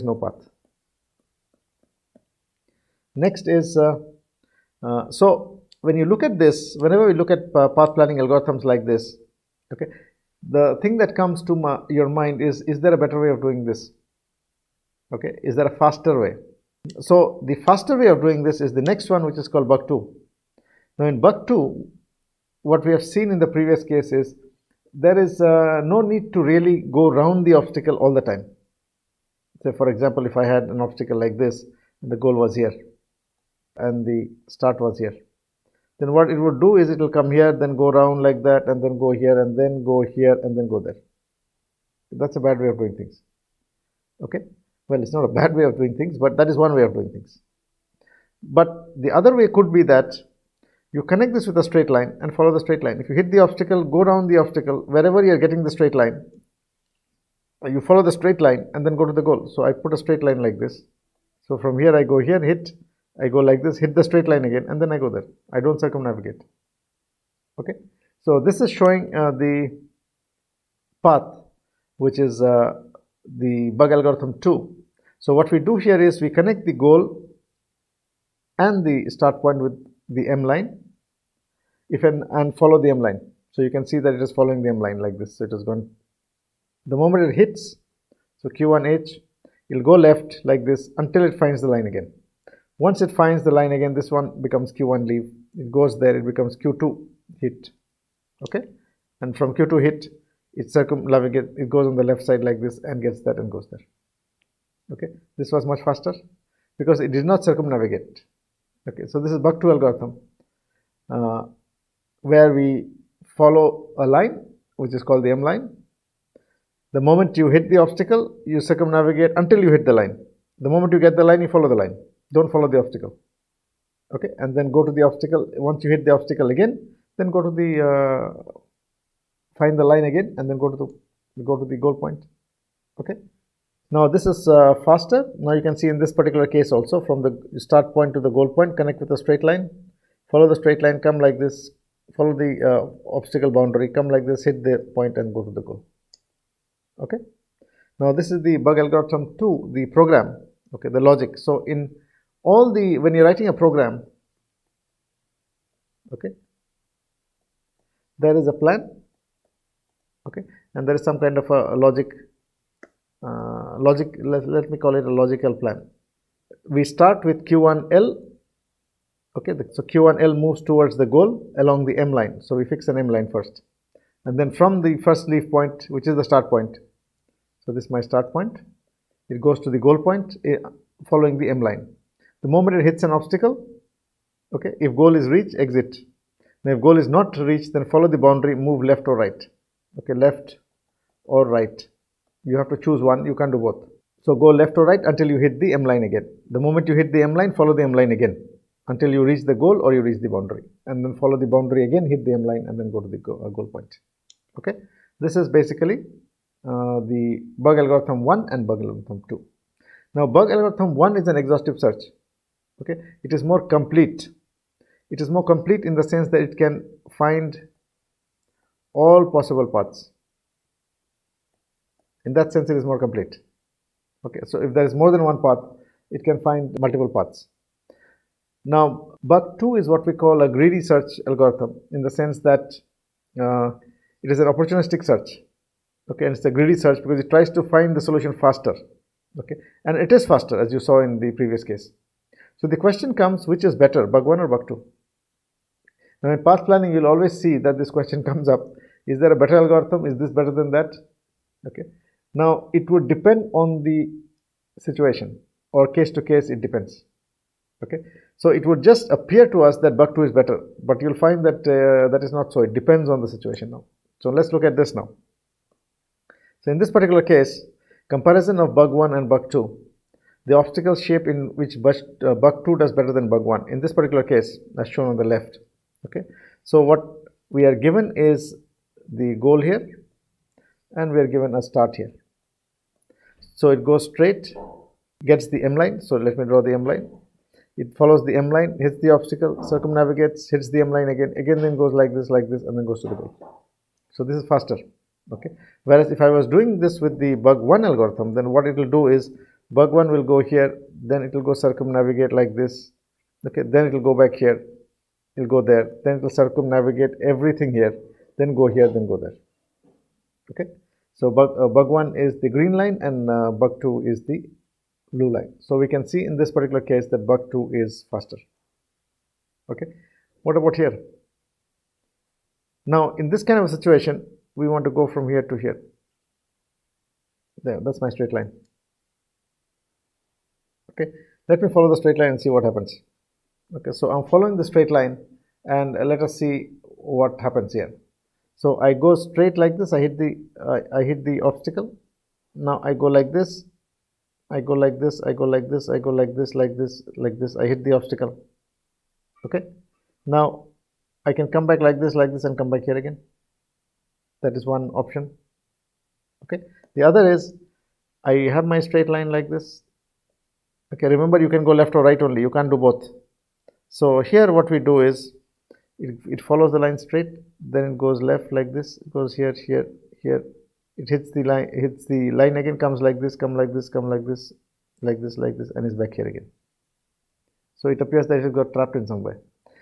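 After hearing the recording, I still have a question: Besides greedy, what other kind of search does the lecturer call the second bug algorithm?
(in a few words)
opportunistic search.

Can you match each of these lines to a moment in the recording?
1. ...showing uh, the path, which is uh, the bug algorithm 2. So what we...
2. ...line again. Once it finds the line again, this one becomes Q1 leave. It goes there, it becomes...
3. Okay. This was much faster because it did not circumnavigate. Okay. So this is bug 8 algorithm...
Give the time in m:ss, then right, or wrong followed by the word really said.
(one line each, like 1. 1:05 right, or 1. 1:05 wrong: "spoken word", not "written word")
1. 1:08 right
2. 1:31 right
3. 1:44 wrong: "2", not "8".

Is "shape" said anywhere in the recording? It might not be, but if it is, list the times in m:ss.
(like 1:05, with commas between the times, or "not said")
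4:30.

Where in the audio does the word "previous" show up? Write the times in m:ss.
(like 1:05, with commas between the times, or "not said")
0:23, 4:01.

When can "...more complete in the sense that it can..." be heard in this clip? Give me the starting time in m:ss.
3:35.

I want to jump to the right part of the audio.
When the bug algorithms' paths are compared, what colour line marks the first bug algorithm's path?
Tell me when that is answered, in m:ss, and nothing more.
5:12.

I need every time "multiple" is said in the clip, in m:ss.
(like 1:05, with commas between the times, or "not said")
3:46.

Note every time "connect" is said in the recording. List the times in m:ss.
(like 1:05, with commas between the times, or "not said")
0:51, 1:16, 2:18.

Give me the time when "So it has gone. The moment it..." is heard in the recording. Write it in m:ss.
1:25.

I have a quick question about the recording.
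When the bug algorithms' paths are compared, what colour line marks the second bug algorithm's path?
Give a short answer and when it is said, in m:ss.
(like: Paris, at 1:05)
blue, at 5:15.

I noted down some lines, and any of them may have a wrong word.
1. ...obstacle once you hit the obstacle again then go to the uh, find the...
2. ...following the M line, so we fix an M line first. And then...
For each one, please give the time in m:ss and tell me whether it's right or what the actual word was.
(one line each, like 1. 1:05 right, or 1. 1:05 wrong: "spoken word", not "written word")
1. 2:05 right
2. 2:51 wrong: "along", not "following".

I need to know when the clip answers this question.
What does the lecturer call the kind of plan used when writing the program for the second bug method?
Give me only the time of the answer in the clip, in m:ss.
2:45.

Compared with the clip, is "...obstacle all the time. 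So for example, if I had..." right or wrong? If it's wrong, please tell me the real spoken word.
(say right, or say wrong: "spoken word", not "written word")
right.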